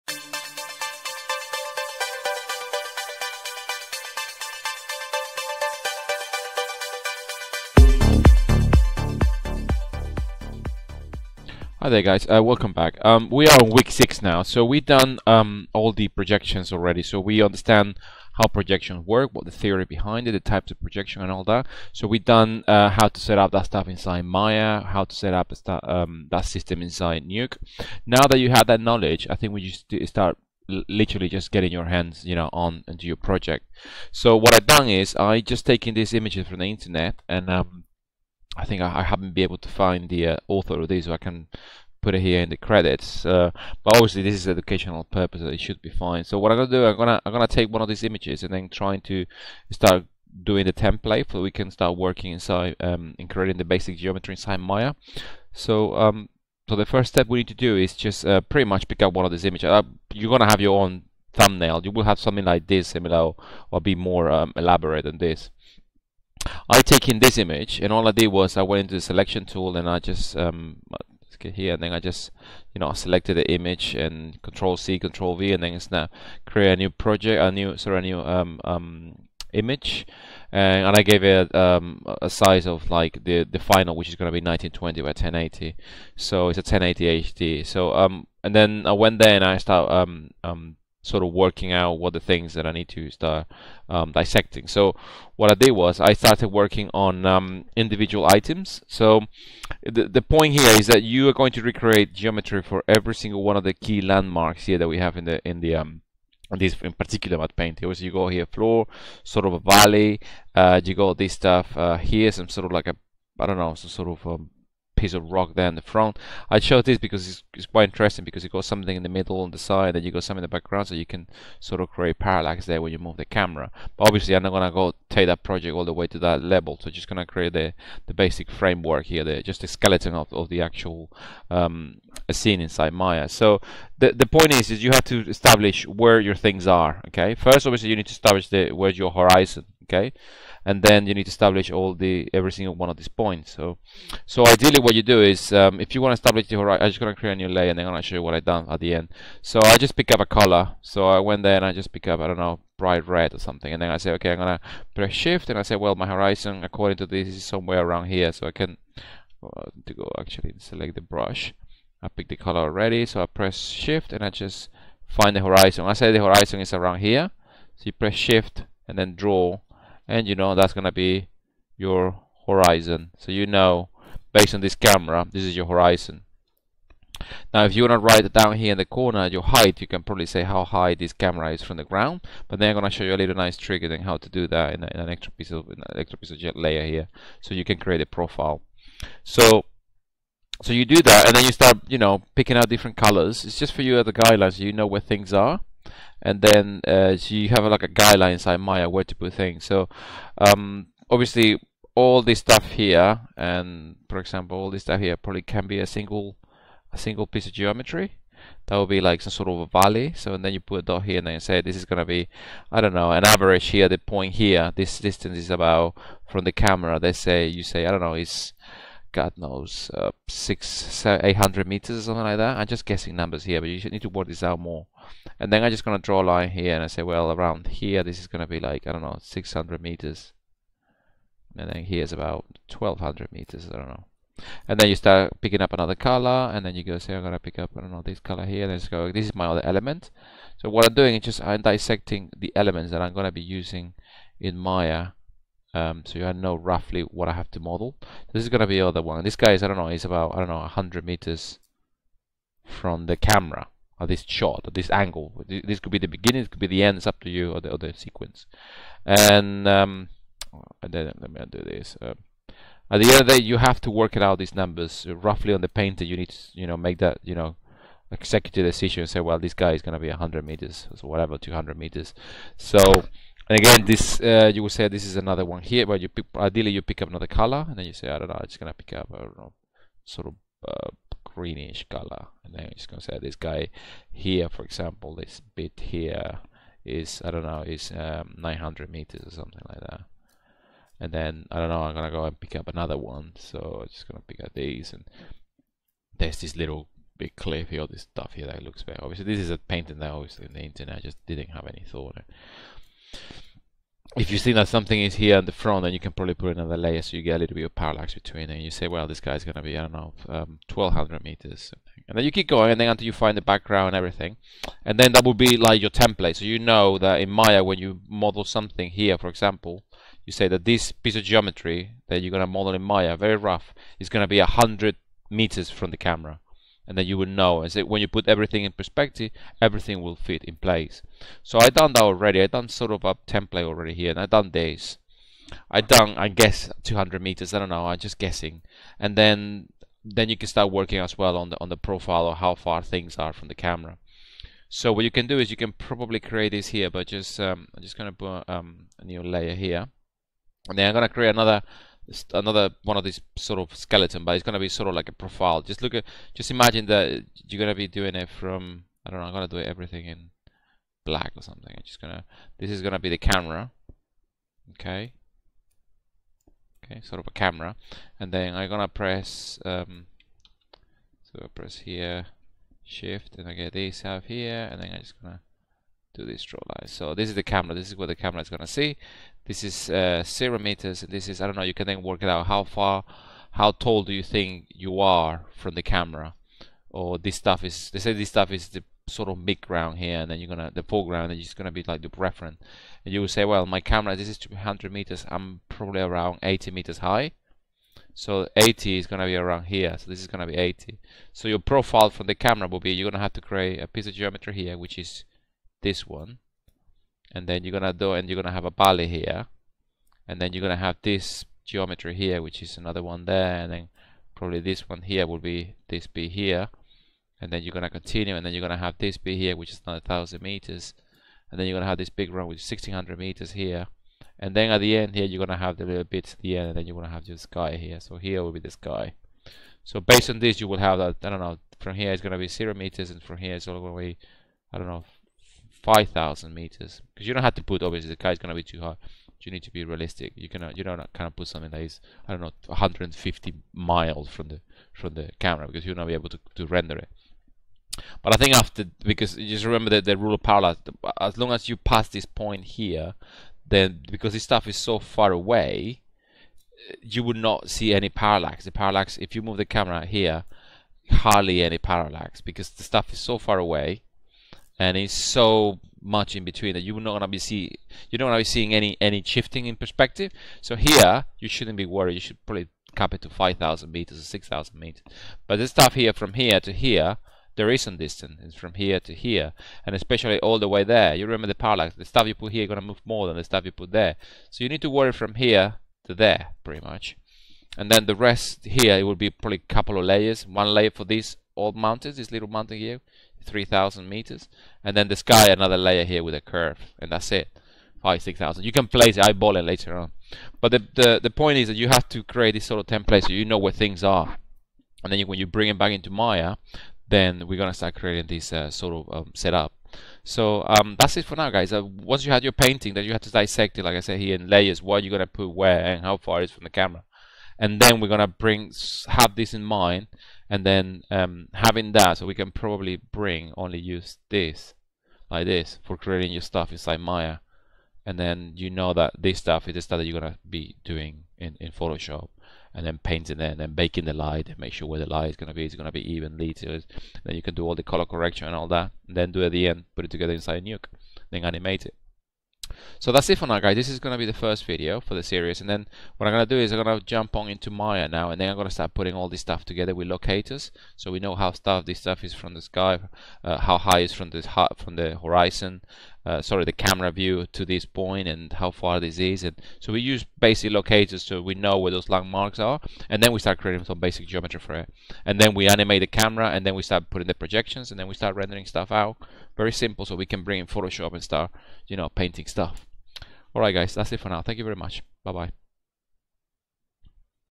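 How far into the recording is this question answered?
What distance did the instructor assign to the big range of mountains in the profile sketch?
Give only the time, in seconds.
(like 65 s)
422 s.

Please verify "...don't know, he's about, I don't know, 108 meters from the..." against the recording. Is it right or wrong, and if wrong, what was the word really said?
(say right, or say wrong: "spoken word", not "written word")
wrong: "100", not "108".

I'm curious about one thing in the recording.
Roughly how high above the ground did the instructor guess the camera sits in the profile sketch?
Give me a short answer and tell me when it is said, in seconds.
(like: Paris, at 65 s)
80 meters, at 396 s.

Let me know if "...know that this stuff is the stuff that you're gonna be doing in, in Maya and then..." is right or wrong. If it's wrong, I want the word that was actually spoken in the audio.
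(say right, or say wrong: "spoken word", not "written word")
wrong: "Photoshop", not "Maya".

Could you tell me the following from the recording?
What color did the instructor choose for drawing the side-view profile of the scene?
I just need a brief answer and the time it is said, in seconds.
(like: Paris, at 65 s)
black, at 361 s.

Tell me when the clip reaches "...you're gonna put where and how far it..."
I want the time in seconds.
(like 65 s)
515 s.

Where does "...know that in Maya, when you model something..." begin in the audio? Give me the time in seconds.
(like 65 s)
316 s.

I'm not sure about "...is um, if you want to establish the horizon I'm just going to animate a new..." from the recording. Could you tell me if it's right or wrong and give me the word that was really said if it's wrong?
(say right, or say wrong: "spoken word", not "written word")
wrong: "create", not "animate".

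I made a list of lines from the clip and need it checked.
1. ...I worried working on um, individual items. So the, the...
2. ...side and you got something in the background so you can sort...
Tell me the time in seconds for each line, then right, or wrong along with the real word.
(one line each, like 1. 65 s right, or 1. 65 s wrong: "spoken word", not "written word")
1. 95 s wrong: "started", not "worried"
2. 119 s right.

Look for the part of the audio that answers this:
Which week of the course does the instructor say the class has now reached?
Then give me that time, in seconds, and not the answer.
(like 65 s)
13 s.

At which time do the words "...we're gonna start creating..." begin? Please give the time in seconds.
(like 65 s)
507 s.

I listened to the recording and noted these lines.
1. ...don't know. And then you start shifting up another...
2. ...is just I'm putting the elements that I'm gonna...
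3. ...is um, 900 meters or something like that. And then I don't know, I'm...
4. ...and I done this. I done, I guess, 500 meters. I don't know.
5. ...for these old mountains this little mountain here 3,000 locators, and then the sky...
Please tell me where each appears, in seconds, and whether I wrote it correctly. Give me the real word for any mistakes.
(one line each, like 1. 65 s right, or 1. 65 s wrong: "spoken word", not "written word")
1. 233 s wrong: "picking", not "shifting"
2. 241 s wrong: "dissecting", not "putting"
3. 287 s right
4. 334 s wrong: "200", not "500"
5. 490 s wrong: "meters", not "locators".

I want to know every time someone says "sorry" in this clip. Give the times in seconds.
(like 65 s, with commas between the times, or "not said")
77 s, 556 s.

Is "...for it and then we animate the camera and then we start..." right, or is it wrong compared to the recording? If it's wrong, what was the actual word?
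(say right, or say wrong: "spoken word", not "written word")
right.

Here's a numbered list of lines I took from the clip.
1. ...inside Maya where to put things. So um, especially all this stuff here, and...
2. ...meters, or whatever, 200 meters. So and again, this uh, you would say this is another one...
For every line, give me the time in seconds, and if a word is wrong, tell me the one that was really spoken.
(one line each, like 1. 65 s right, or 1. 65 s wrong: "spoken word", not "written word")
1. 198 s wrong: "obviously", not "especially"
2. 270 s right.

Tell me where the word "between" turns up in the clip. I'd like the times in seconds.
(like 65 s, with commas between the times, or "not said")
308 s, 466 s.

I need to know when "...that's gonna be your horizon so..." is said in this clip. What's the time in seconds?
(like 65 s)
170 s.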